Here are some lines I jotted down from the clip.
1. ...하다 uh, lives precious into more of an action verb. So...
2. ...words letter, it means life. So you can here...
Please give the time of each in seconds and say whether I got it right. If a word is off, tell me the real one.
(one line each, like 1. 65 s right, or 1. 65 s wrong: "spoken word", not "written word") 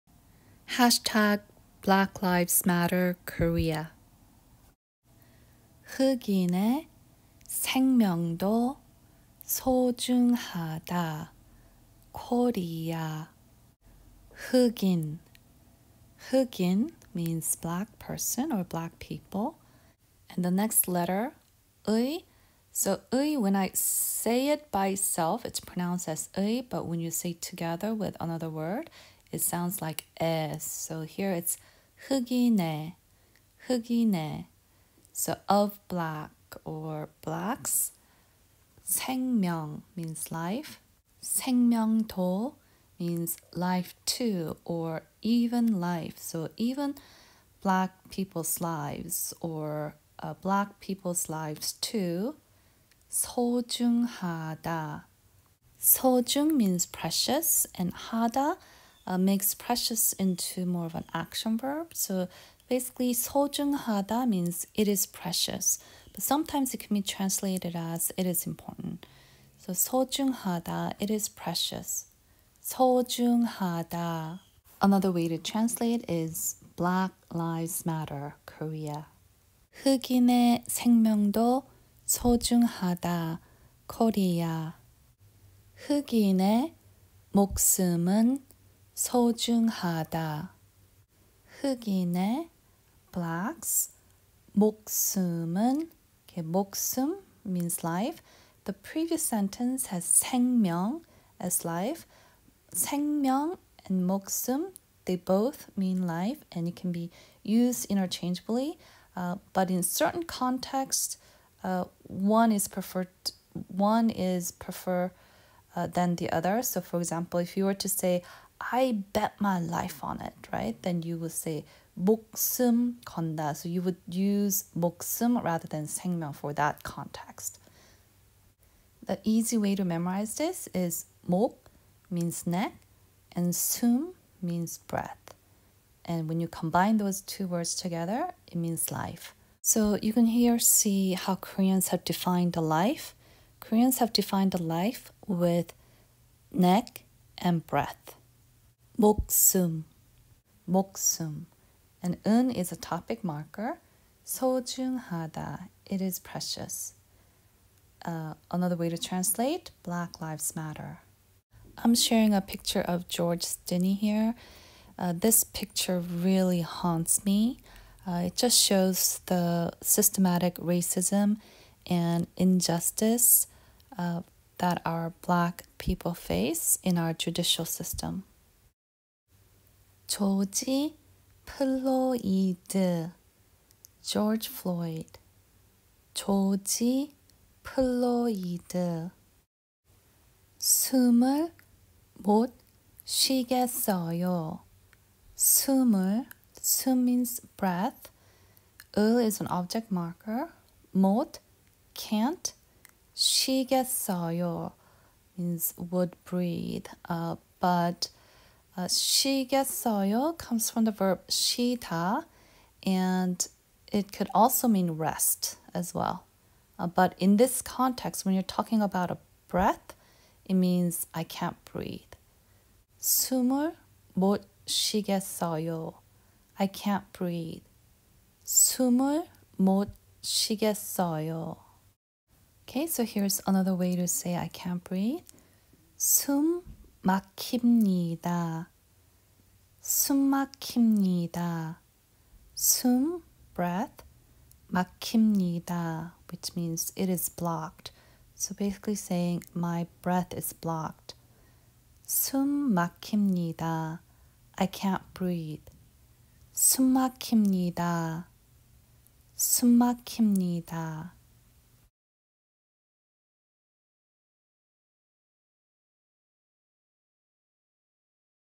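1. 57 s wrong: "makes", not "lives"
2. 137 s wrong: "together", not "letter".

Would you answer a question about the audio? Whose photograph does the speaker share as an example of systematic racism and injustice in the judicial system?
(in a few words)
George Stinney.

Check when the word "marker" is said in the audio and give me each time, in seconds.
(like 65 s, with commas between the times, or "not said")
153 s, 199 s.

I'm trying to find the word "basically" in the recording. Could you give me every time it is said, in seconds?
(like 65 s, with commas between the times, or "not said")
62 s, 248 s.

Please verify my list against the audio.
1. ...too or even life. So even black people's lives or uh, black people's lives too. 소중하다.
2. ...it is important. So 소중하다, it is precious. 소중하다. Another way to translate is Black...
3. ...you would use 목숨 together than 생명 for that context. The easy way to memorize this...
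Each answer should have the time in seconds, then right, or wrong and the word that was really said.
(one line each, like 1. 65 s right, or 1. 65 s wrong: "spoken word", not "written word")
1. 44 s right
2. 68 s right
3. 123 s wrong: "rather", not "together".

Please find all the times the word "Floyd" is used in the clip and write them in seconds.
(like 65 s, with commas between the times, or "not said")
184 s.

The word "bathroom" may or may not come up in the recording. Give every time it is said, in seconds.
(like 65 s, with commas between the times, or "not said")
not said.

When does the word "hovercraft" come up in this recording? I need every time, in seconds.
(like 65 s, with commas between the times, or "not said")
not said.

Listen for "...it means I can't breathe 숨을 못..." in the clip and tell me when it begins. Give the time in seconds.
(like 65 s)
220 s.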